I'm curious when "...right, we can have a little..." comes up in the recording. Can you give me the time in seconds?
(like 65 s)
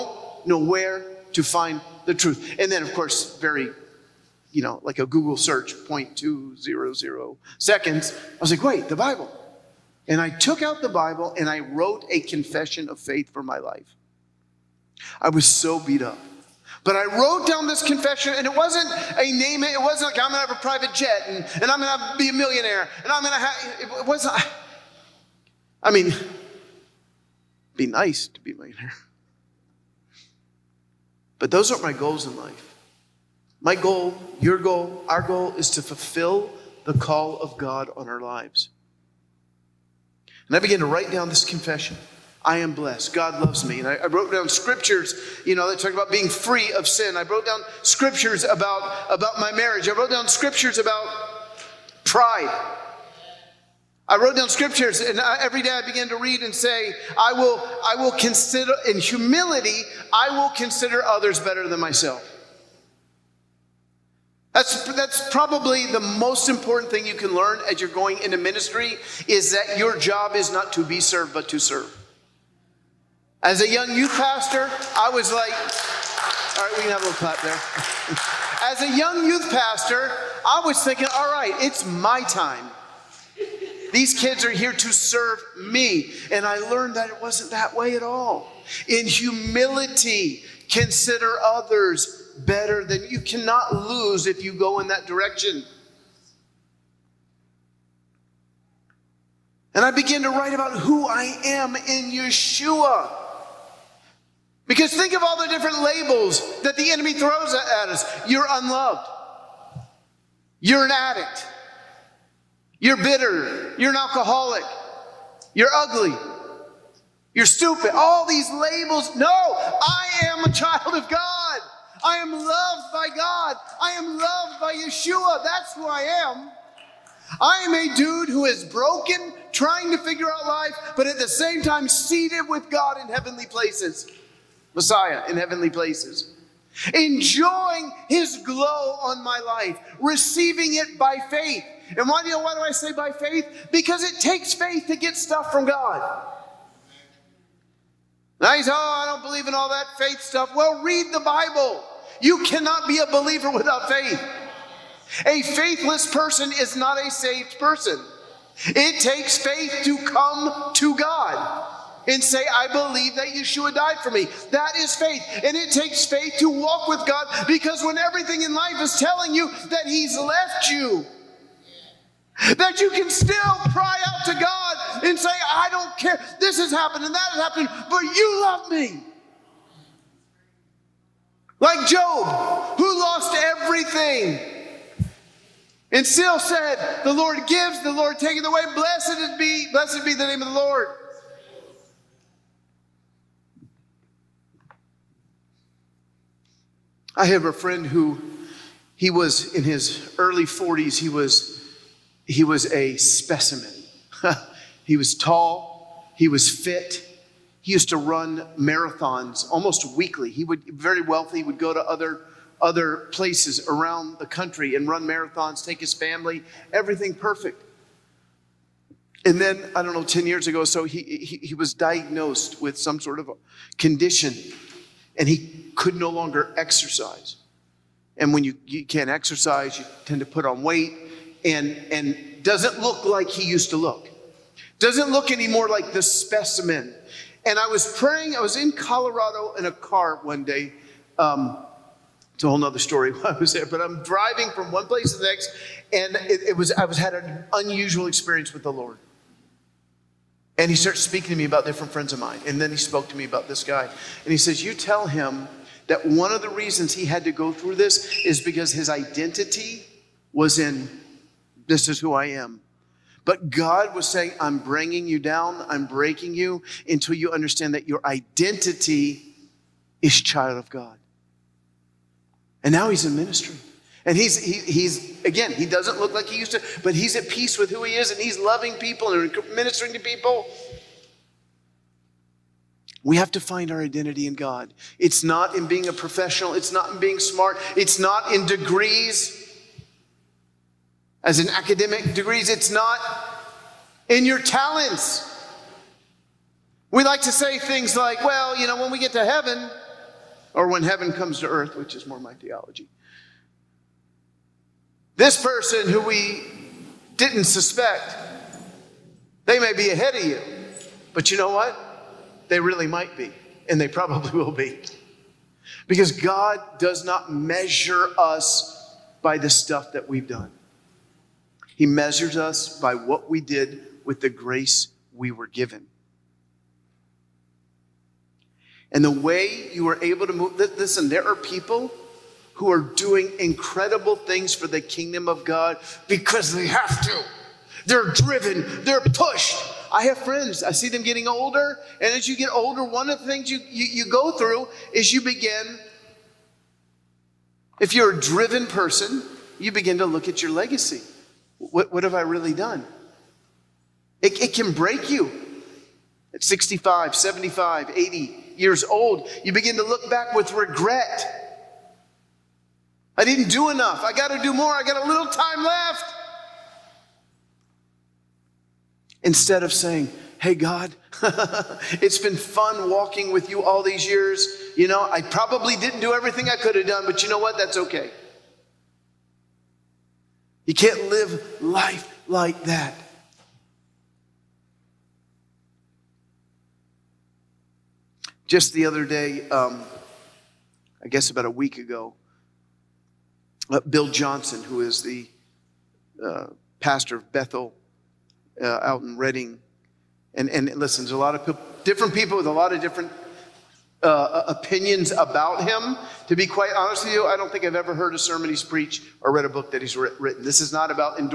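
76 s.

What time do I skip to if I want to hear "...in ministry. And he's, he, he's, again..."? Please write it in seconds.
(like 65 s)
273 s.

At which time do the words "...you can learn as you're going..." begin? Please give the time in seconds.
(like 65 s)
67 s.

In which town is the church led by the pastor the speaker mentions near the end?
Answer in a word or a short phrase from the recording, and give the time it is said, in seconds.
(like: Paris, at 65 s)
Redding, at 399 s.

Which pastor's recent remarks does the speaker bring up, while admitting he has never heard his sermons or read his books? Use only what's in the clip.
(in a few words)
Bill Johnson.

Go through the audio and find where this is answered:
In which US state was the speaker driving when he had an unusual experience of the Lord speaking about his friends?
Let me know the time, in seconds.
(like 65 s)
238 s.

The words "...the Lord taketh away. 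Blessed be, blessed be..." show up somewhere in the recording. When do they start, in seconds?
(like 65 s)
187 s.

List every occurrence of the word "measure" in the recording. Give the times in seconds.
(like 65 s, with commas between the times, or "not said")
317 s, 321 s.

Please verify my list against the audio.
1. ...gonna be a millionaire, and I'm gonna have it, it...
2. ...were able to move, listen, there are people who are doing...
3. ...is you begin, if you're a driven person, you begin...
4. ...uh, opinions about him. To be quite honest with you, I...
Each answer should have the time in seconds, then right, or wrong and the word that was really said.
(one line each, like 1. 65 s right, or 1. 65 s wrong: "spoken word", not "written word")
1. 21 s right
2. 329 s right
3. 344 s right
4. 404 s right.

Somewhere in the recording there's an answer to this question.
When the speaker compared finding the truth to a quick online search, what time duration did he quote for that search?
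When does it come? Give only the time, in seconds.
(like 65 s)
5 s.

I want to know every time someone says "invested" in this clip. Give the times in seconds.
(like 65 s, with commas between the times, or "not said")
not said.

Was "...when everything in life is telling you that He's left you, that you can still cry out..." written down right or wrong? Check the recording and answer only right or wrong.
right.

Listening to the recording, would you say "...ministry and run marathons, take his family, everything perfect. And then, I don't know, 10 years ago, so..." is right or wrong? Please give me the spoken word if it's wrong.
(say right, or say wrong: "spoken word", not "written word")
wrong: "country", not "ministry".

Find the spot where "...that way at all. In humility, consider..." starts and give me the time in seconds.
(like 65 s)
87 s.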